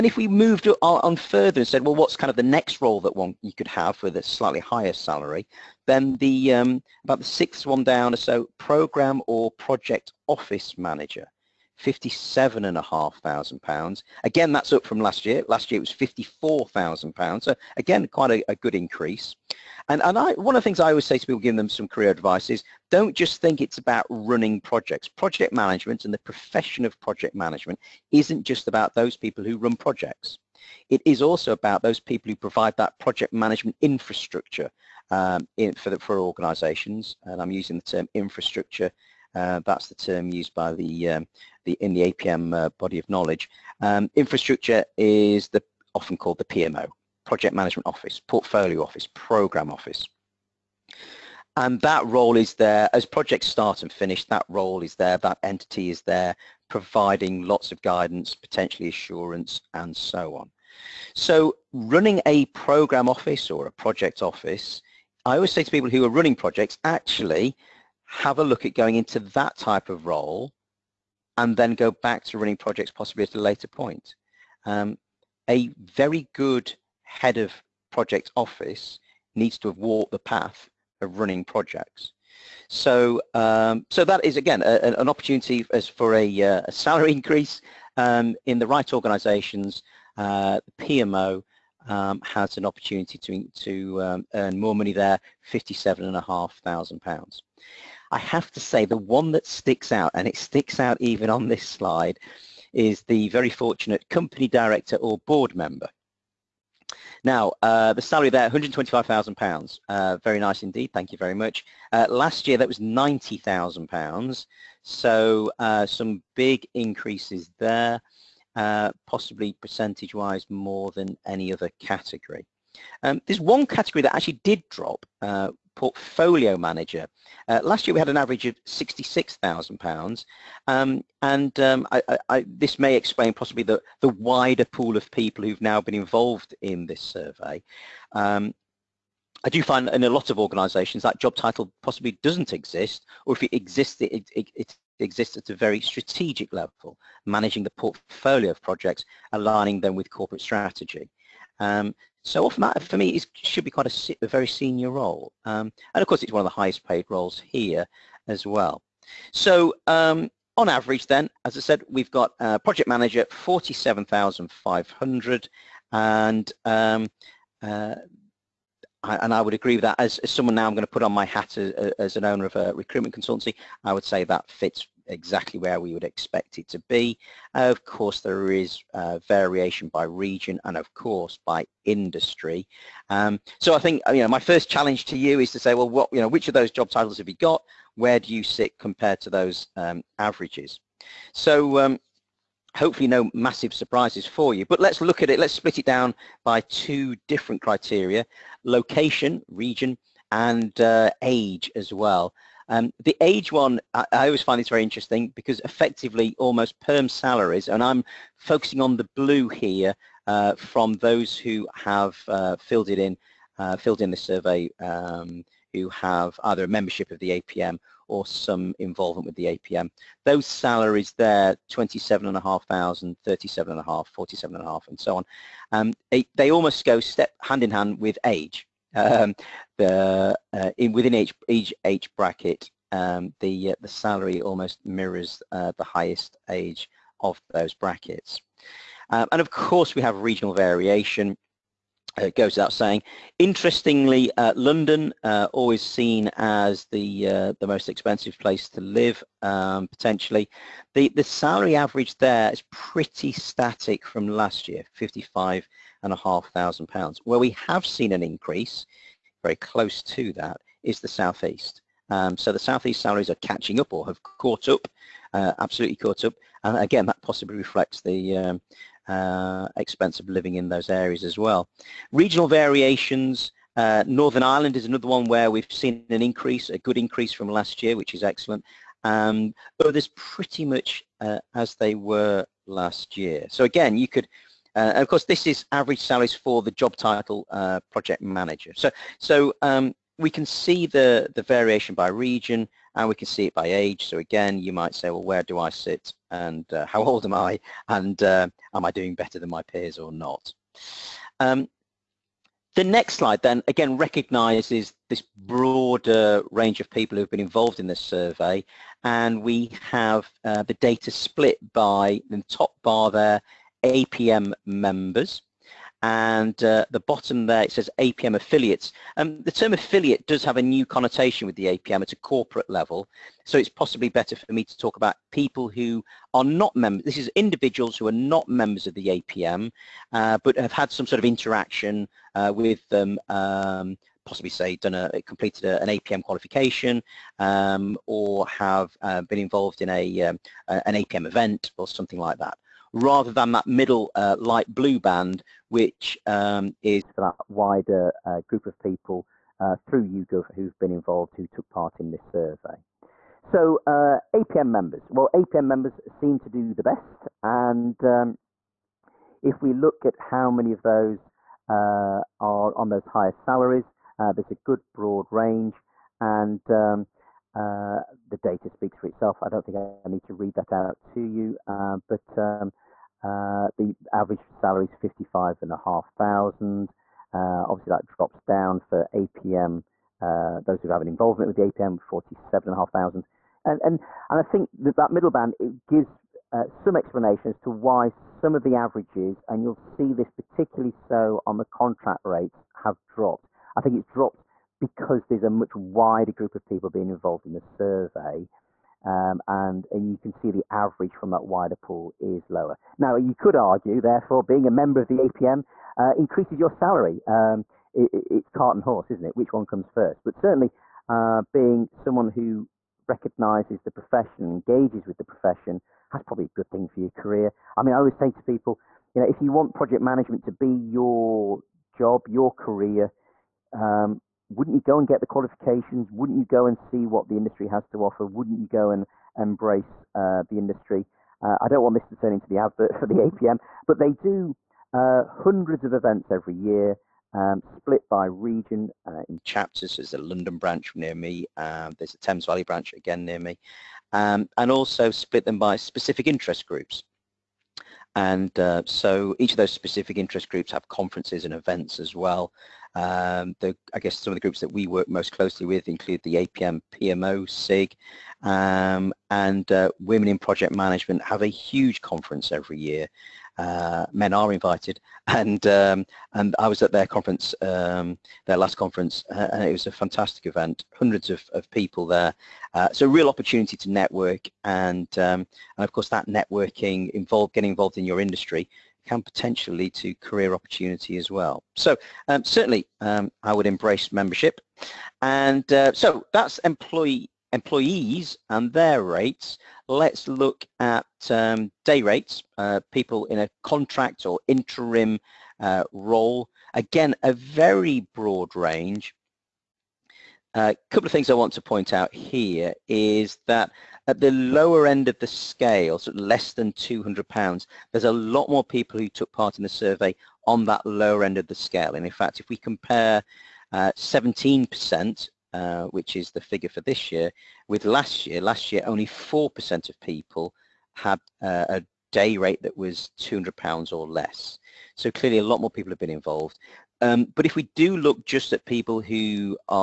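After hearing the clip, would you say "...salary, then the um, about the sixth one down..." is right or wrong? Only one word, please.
right.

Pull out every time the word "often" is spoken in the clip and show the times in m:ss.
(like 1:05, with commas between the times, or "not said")
0:45, 2:32.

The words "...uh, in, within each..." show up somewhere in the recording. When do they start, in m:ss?
3:50.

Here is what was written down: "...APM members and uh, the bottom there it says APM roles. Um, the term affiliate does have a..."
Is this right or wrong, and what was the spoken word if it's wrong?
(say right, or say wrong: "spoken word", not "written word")
wrong: "affiliates", not "roles".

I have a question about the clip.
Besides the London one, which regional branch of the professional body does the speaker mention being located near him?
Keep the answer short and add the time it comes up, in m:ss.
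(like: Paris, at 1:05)
Thames Valley, at 7:22.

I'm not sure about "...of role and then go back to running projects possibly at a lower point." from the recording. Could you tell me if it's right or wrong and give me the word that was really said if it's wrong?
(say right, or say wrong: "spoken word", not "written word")
wrong: "later", not "lower".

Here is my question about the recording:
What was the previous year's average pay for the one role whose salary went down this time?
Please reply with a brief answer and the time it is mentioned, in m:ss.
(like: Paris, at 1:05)
£66,000, at 2:08.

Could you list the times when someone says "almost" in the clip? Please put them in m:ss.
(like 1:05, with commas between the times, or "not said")
3:26, 3:46, 3:54.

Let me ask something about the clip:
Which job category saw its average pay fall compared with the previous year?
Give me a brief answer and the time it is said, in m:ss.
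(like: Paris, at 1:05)
Portfolio manager, at 2:05.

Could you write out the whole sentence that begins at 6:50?
But certainly uh, being someone who recognizes the profession, engages with the profession, that's probably a good thing for your career.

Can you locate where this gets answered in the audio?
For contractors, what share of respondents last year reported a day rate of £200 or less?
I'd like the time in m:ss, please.
8:39.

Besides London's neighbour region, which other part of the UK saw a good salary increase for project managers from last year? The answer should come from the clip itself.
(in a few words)
Northern Ireland.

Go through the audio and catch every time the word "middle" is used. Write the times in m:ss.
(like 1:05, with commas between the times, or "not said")
5:43, 6:25.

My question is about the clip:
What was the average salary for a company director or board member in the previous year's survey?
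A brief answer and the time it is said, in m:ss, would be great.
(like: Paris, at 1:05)
£90,000, at 1:52.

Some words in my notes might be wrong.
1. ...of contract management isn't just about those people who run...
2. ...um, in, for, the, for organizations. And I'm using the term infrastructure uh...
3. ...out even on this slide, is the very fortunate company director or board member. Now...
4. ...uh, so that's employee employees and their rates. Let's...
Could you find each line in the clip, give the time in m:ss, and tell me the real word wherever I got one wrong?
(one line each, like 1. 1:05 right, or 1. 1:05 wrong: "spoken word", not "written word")
1. 0:26 wrong: "project", not "contract"
2. 0:35 right
3. 1:40 right
4. 8:05 right.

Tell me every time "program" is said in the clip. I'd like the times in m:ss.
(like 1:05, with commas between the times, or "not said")
0:08, 0:49, 1:02.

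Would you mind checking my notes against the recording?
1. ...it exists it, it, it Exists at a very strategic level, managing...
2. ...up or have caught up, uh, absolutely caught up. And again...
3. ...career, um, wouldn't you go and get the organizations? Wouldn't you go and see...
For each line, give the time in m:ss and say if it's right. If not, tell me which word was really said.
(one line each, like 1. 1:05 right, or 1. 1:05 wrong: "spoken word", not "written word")
1. 2:23 right
2. 4:23 right
3. 7:02 wrong: "qualifications", not "organizations".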